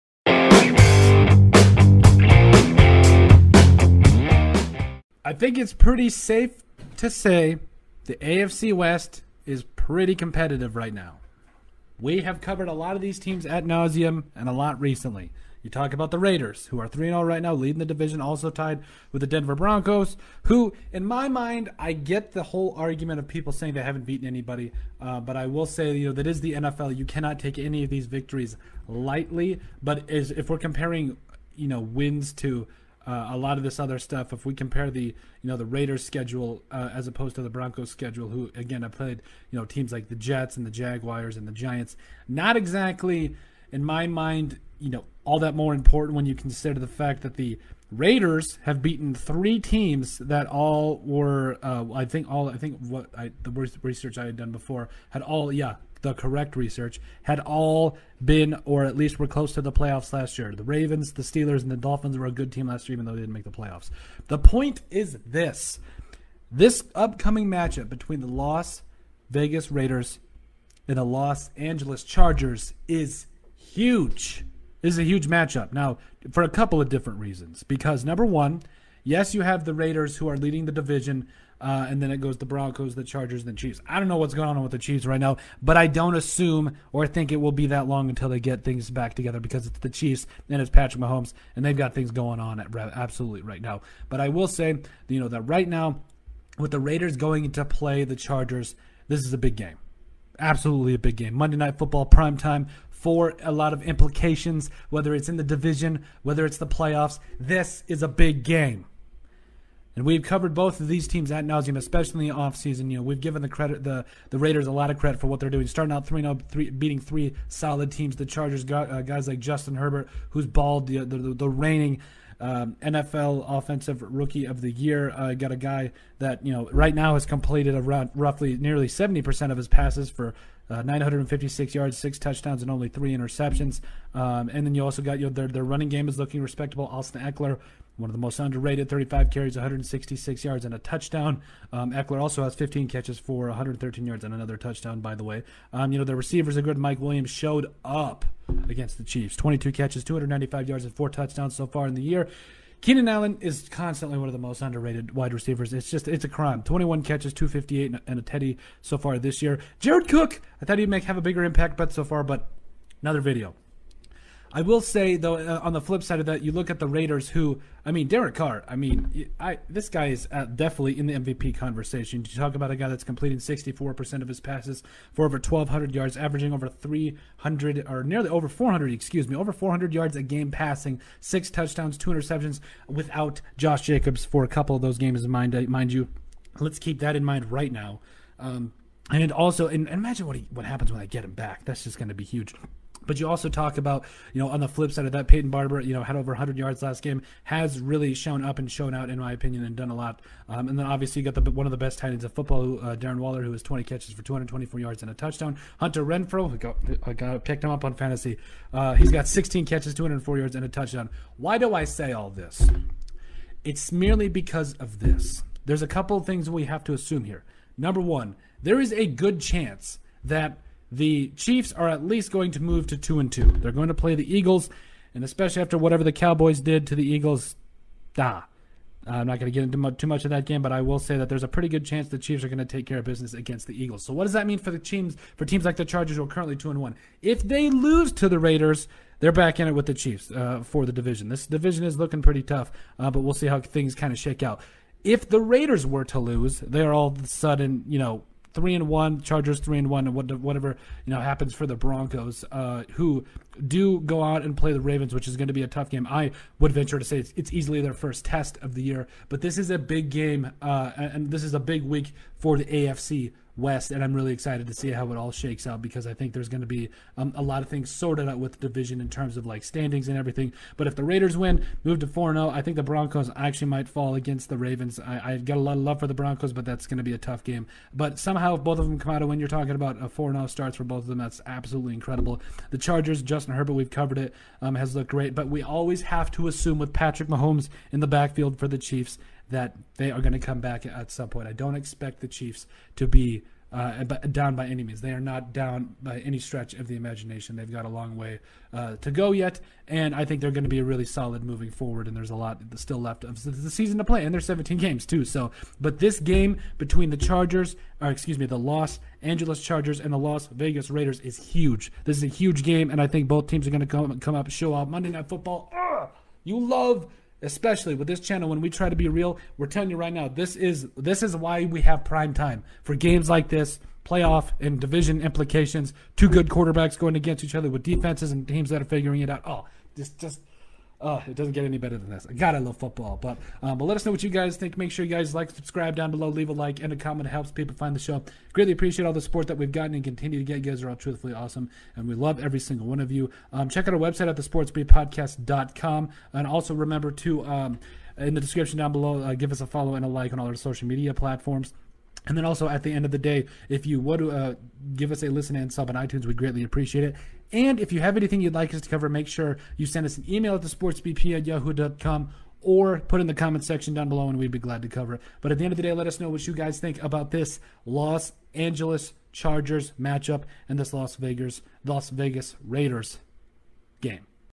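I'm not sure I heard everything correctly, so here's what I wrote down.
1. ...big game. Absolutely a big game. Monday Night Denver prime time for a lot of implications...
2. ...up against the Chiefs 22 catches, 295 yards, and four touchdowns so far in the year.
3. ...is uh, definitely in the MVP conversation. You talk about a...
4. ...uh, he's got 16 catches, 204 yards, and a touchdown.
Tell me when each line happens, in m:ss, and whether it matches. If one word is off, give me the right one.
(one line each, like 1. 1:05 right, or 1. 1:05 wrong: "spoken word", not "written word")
1. 1:39 wrong: "Football", not "Denver"
2. 2:27 right
3. 2:50 right
4. 3:28 right.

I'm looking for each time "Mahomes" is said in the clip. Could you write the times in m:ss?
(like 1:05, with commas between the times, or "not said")
1:31, 4:47.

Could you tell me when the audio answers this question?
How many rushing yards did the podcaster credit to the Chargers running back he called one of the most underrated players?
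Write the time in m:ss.
2:19.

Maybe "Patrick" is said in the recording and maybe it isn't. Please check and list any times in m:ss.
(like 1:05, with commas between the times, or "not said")
1:30, 4:46.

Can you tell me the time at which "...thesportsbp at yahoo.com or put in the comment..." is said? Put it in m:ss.
6:00.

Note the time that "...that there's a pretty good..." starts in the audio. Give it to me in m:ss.
3:51.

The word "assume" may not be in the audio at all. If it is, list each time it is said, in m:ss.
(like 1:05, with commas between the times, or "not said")
1:26, 3:36, 4:46.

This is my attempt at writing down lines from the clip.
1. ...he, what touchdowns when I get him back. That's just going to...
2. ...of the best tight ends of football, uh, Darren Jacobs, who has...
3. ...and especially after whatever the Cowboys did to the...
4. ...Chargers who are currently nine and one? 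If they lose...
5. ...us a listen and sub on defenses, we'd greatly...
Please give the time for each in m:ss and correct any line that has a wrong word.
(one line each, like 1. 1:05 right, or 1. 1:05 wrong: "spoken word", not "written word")
1. 3:10 wrong: "happens", not "touchdowns"
2. 3:21 wrong: "Waller", not "Jacobs"
3. 3:45 right
4. 3:55 wrong: "two", not "nine"
5. 5:55 wrong: "iTunes", not "defenses".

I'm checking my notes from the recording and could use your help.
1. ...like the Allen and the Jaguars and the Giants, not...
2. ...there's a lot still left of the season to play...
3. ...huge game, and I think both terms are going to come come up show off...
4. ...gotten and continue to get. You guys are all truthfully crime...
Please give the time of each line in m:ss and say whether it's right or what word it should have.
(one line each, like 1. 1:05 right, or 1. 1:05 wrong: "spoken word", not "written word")
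1. 0:39 wrong: "Jets", not "Allen"
2. 5:02 right
3. 5:12 wrong: "teams", not "terms"
4. 5:39 wrong: "awesome", not "crime".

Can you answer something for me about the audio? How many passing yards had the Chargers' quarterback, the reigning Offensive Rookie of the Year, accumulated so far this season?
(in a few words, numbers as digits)
956.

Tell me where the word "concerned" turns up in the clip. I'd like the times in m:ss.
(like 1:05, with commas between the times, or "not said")
not said.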